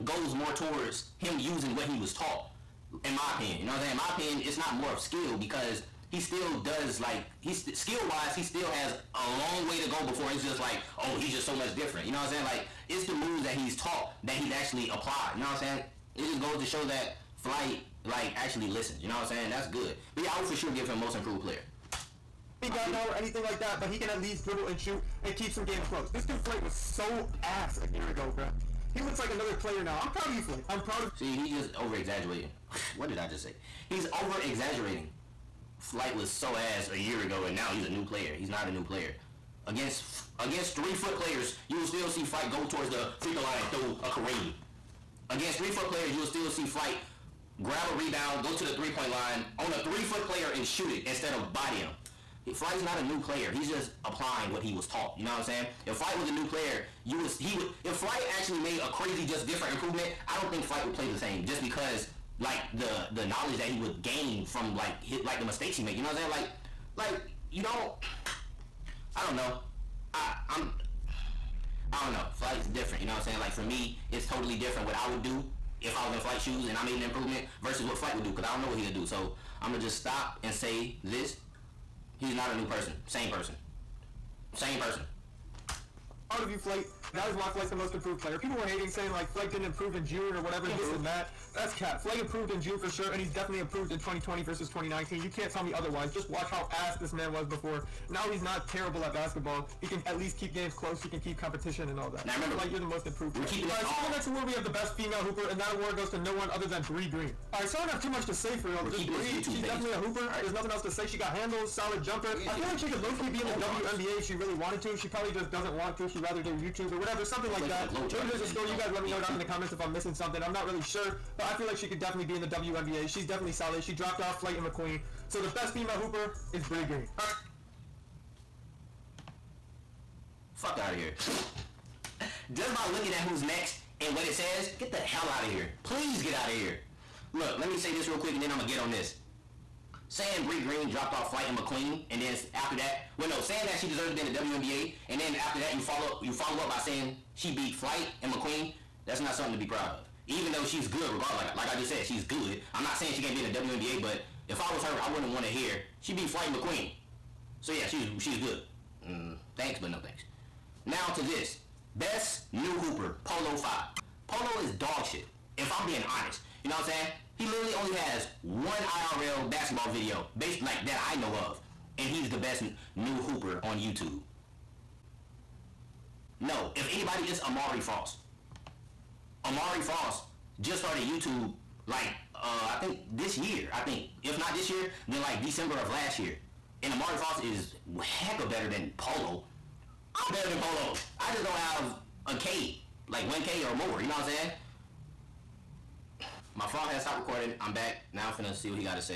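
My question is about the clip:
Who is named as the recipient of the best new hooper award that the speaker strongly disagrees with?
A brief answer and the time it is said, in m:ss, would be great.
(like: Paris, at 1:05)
Polo Five, at 2:43.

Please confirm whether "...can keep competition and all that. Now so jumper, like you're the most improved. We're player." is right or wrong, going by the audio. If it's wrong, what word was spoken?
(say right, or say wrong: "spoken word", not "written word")
wrong: "remember", not "jumper".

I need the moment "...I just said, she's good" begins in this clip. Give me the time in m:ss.
2:31.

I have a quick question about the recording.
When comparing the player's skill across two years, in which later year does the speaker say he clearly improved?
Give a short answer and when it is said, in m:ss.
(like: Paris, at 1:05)
2020, at 1:33.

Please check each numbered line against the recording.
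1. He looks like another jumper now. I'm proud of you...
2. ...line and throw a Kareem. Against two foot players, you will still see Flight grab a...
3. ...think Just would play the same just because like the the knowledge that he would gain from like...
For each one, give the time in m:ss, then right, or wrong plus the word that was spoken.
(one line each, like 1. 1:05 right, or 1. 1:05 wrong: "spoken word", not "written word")
1. 0:28 wrong: "player", not "jumper"
2. 0:43 wrong: "three", not "two"
3. 1:00 wrong: "Flight", not "Just".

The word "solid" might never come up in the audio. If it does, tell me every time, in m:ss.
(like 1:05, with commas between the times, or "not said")
1:51, 2:03.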